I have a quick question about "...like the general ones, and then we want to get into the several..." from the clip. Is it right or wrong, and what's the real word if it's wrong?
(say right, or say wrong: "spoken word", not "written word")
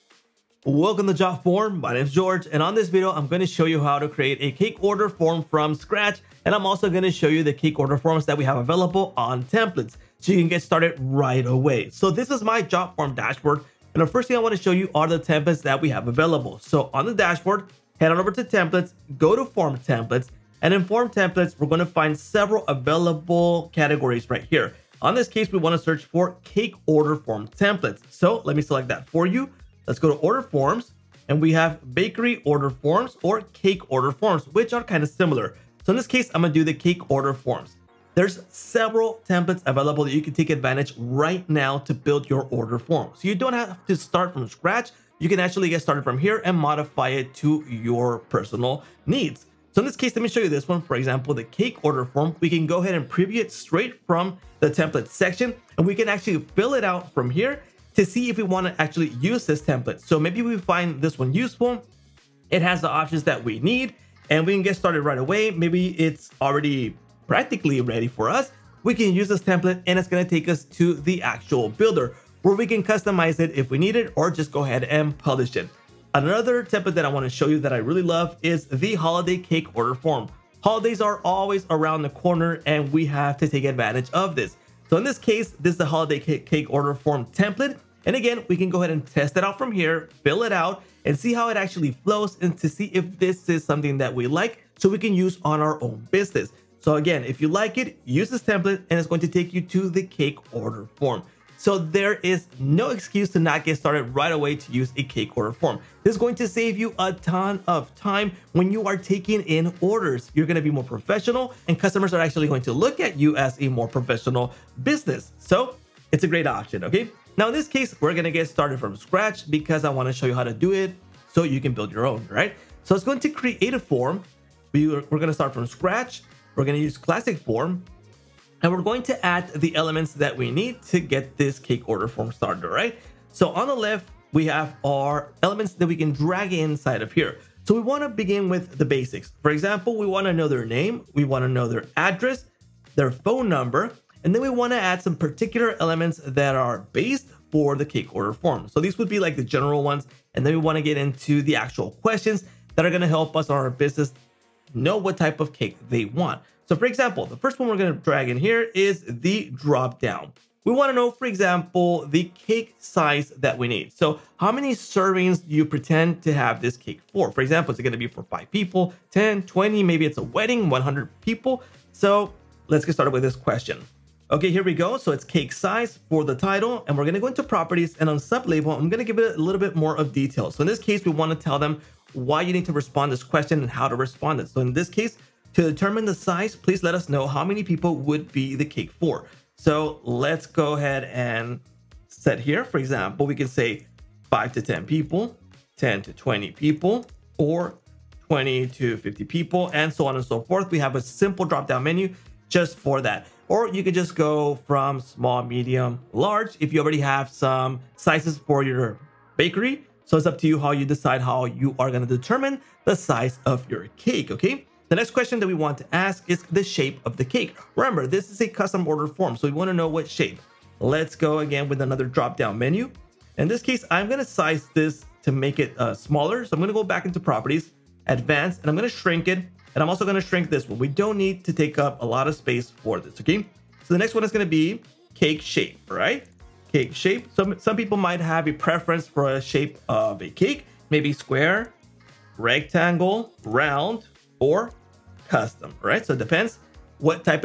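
wrong: "actual", not "several".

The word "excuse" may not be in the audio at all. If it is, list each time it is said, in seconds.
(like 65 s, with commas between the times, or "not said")
102 s.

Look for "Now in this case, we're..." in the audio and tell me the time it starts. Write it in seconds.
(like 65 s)
117 s.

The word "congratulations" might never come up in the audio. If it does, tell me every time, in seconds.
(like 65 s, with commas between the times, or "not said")
not said.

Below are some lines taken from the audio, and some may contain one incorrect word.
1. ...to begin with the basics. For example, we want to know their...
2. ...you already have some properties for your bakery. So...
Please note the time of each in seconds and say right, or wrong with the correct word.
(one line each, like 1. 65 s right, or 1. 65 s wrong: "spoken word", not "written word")
1. 138 s right
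2. 206 s wrong: "sizes", not "properties".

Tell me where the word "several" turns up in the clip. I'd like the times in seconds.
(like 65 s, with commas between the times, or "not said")
22 s, 38 s.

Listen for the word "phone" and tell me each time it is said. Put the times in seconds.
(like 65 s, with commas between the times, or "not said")
143 s.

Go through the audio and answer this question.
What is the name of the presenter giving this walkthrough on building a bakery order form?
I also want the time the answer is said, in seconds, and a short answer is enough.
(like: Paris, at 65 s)
George, at 2 s.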